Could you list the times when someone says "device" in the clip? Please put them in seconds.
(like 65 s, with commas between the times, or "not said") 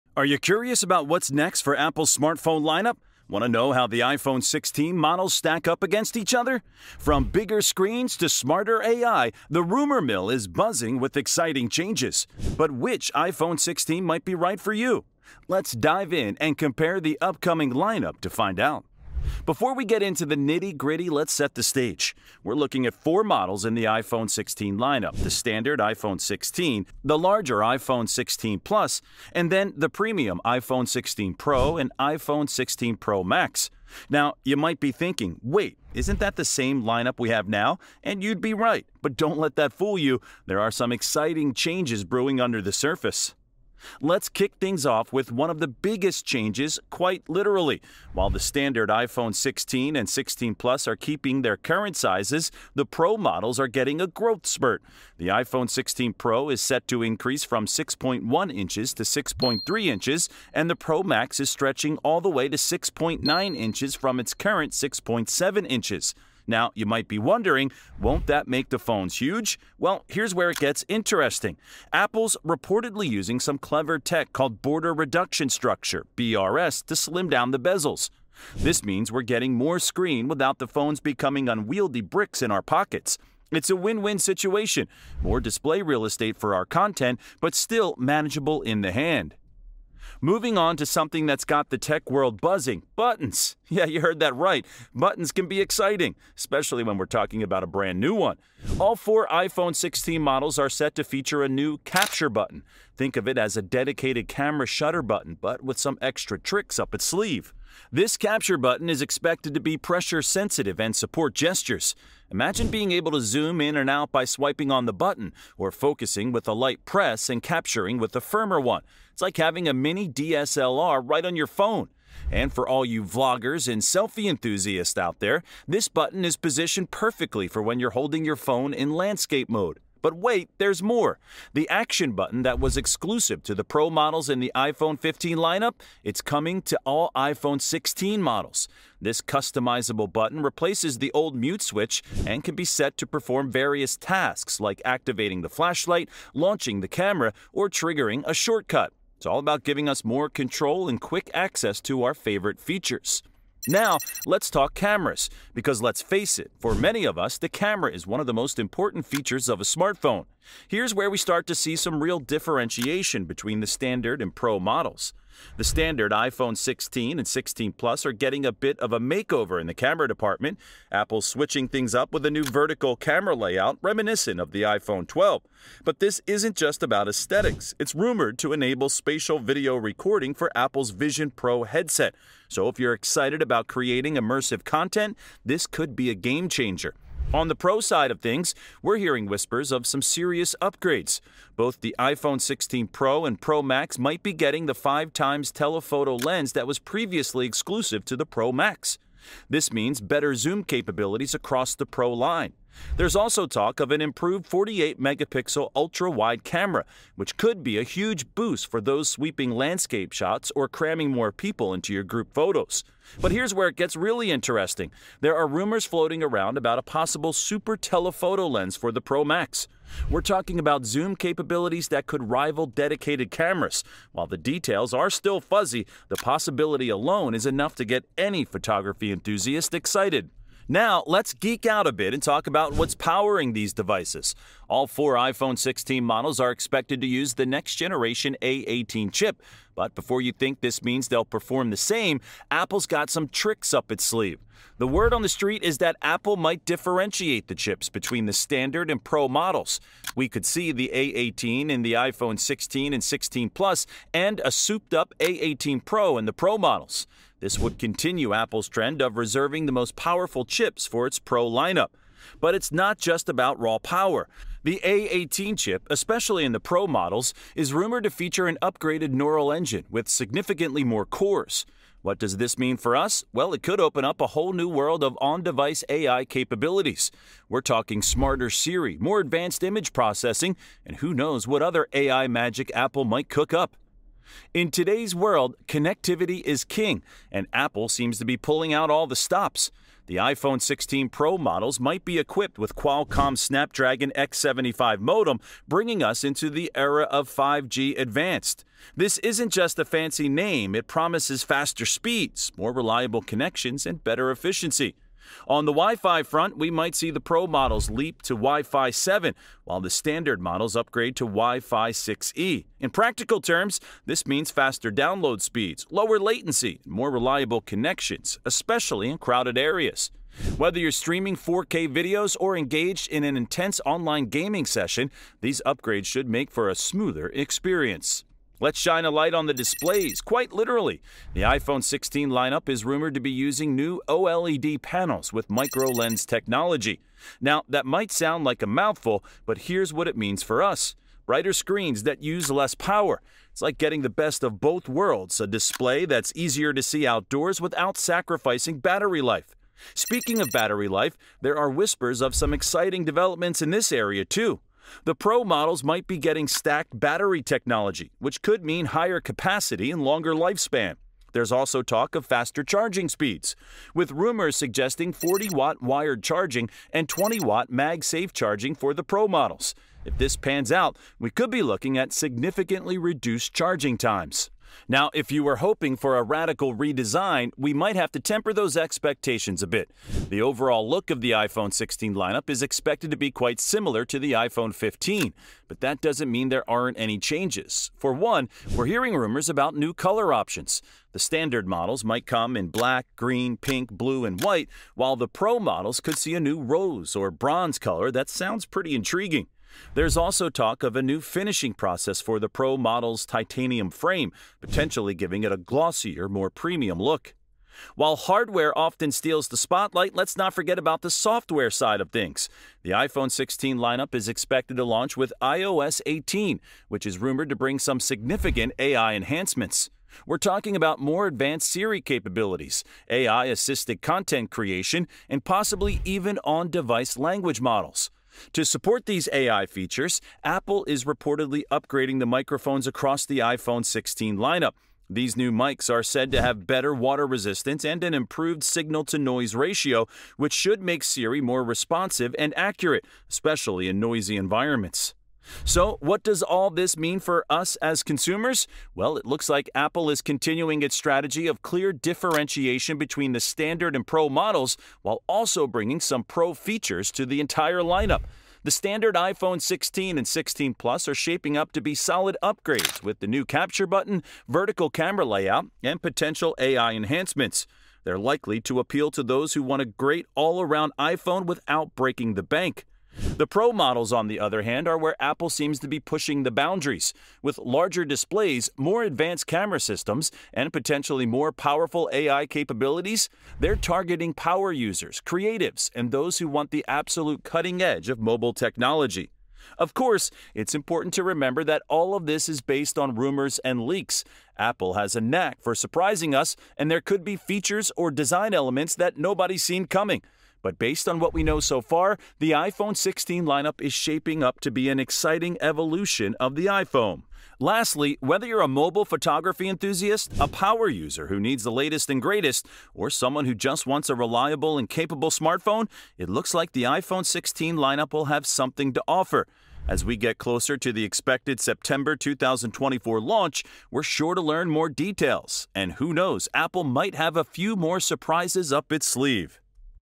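233 s, 275 s, 426 s.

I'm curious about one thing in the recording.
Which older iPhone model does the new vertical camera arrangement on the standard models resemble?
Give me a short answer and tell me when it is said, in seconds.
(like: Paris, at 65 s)
iPhone 12, at 174 s.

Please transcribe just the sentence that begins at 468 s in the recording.
They're likely to appeal to those who want a great all around iPhone without breaking the bank.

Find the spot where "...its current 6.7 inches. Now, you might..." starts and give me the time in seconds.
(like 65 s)
64 s.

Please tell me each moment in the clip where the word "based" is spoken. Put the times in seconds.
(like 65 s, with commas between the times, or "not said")
492 s, 500 s.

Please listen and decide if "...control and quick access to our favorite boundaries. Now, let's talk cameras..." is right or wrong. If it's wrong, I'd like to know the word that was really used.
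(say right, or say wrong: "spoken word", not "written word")
wrong: "features", not "boundaries".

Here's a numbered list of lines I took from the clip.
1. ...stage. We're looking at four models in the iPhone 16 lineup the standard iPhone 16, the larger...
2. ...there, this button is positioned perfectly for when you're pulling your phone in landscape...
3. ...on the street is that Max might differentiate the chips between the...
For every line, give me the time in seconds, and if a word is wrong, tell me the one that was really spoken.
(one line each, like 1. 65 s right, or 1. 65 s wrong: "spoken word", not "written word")
1. 21 s right
2. 125 s wrong: "holding", not "pulling"
3. 245 s wrong: "Apple", not "Max".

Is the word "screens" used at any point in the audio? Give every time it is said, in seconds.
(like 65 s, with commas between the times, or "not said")
7 s, 79 s, 341 s.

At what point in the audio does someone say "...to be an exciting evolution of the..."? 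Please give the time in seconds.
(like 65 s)
504 s.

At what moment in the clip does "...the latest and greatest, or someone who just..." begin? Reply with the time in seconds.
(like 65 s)
511 s.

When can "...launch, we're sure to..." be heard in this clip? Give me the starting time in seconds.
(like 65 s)
523 s.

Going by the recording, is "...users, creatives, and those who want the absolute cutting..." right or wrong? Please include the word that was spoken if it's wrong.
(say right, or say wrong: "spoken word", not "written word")
right.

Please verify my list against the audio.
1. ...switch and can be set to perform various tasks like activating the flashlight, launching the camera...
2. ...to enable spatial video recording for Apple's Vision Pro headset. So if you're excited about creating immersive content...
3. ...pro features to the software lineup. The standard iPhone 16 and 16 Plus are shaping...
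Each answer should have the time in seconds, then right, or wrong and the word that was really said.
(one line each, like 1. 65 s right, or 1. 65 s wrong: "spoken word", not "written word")
1. 141 s right
2. 178 s right
3. 456 s wrong: "entire", not "software".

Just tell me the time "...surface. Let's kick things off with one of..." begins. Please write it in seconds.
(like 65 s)
42 s.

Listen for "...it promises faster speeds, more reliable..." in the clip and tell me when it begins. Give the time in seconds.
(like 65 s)
300 s.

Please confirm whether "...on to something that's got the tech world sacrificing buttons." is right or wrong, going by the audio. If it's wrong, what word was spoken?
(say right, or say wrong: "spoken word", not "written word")
wrong: "buzzing", not "sacrificing".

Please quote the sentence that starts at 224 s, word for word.
While the details are still fuzzy, the possibility alone is enough to get any photography enthusiast excited.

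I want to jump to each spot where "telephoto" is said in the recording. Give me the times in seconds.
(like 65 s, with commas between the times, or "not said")
195 s, 217 s.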